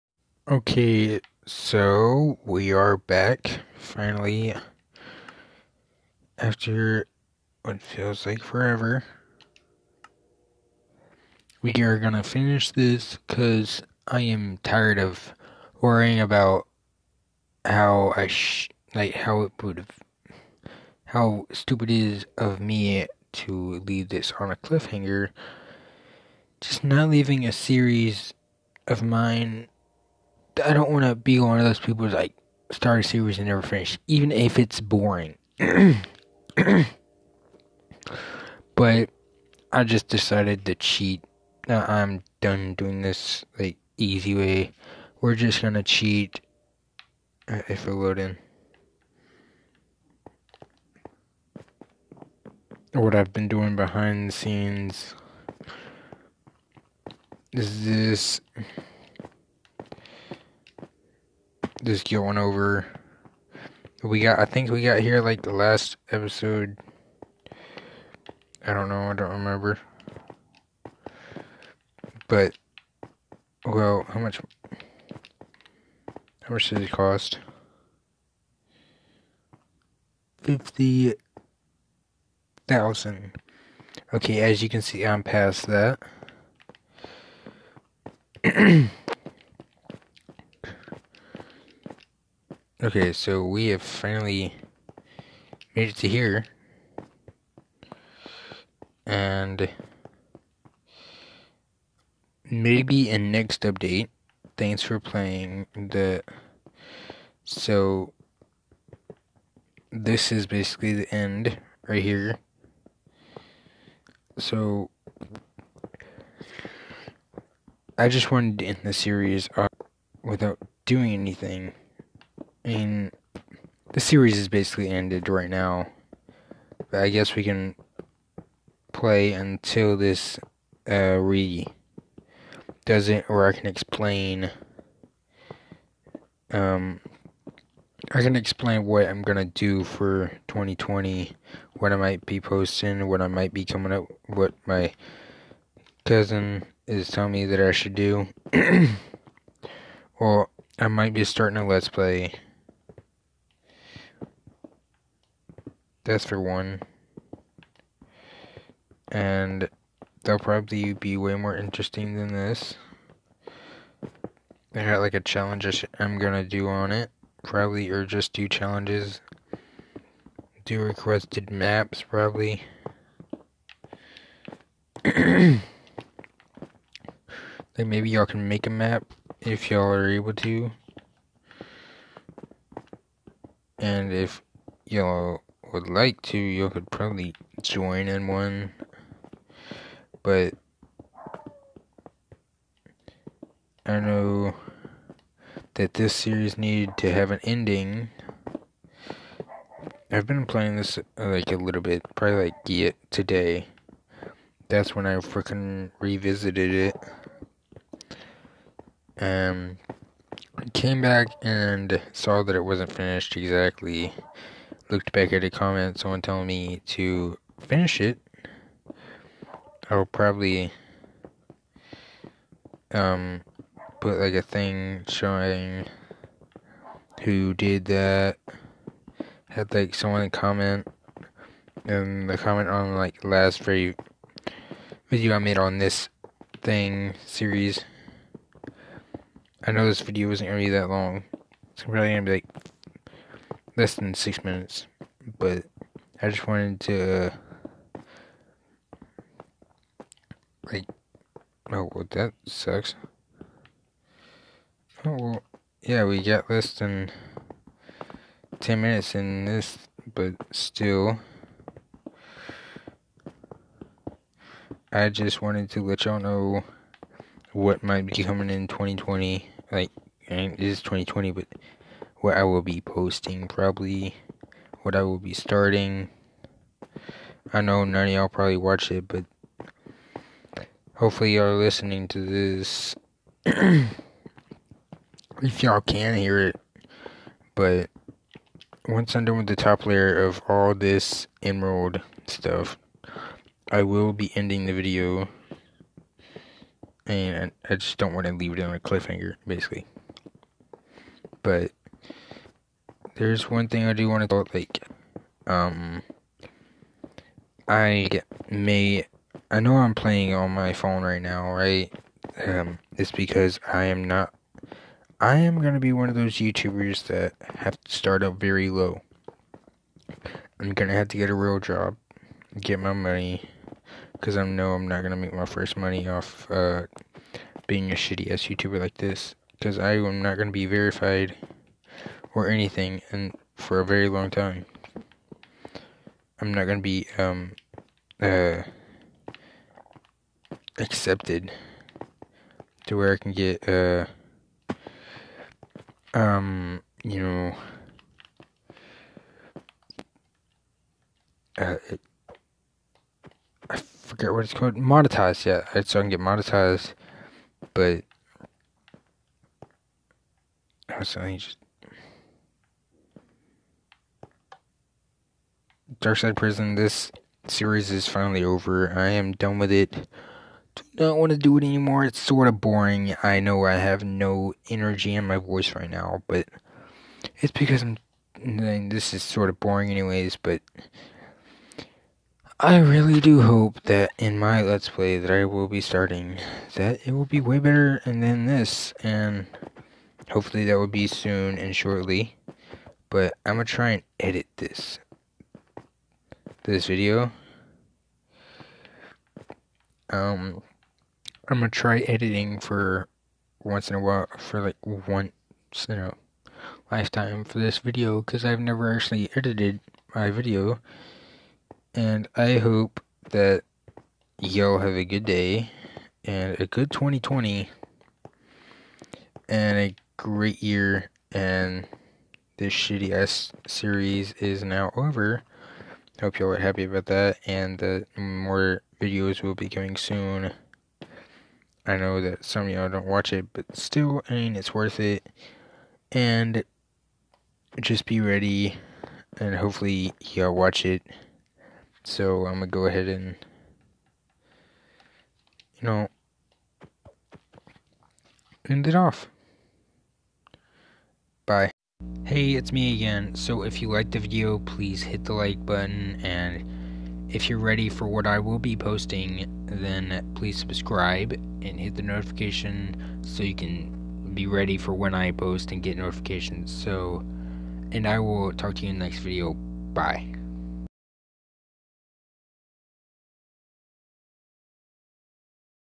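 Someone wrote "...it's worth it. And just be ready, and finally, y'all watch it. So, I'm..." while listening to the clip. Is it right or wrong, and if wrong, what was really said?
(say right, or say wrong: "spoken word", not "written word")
wrong: "hopefully", not "finally".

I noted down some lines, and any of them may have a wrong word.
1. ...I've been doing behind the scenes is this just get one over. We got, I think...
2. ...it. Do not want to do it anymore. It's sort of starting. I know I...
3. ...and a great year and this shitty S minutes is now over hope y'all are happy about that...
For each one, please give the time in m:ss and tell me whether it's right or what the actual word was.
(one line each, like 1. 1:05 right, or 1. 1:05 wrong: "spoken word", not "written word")
1. 0:53 right
2. 6:09 wrong: "boring", not "starting"
3. 6:59 wrong: "series", not "minutes".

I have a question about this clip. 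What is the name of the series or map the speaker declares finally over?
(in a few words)
Dark Side Prison.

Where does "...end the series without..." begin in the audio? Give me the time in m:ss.
1:58.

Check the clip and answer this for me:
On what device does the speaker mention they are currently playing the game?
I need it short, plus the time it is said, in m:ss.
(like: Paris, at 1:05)
phone, at 5:10.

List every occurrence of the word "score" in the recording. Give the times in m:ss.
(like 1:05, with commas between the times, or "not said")
not said.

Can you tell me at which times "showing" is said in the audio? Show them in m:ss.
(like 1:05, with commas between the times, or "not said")
3:45.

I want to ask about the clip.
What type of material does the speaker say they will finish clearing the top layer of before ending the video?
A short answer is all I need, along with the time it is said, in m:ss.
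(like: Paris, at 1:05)
emerald, at 4:51.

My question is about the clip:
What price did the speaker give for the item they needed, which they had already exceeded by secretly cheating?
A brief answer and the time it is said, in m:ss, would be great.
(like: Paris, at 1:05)
50,000, at 1:20.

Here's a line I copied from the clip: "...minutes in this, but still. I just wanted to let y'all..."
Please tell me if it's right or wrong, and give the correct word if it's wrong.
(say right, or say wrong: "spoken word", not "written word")
right.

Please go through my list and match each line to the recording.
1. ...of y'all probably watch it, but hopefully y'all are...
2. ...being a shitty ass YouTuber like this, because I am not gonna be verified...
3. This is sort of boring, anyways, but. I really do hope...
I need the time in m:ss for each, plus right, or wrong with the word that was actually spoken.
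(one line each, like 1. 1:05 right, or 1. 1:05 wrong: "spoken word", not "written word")
1. 4:38 right
2. 5:27 right
3. 6:18 right.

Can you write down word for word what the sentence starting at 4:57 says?
And I just don't want to leave it on a cliffhanger, basically.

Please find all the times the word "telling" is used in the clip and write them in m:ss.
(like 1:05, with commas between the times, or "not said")
2:27, 3:36.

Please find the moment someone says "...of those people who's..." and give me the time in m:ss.
0:31.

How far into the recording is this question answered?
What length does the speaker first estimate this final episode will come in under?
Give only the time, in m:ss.
4:04.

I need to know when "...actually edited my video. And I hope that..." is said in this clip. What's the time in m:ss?
6:48.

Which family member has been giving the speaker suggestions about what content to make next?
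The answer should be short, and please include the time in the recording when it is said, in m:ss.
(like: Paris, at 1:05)
cousin, at 2:26.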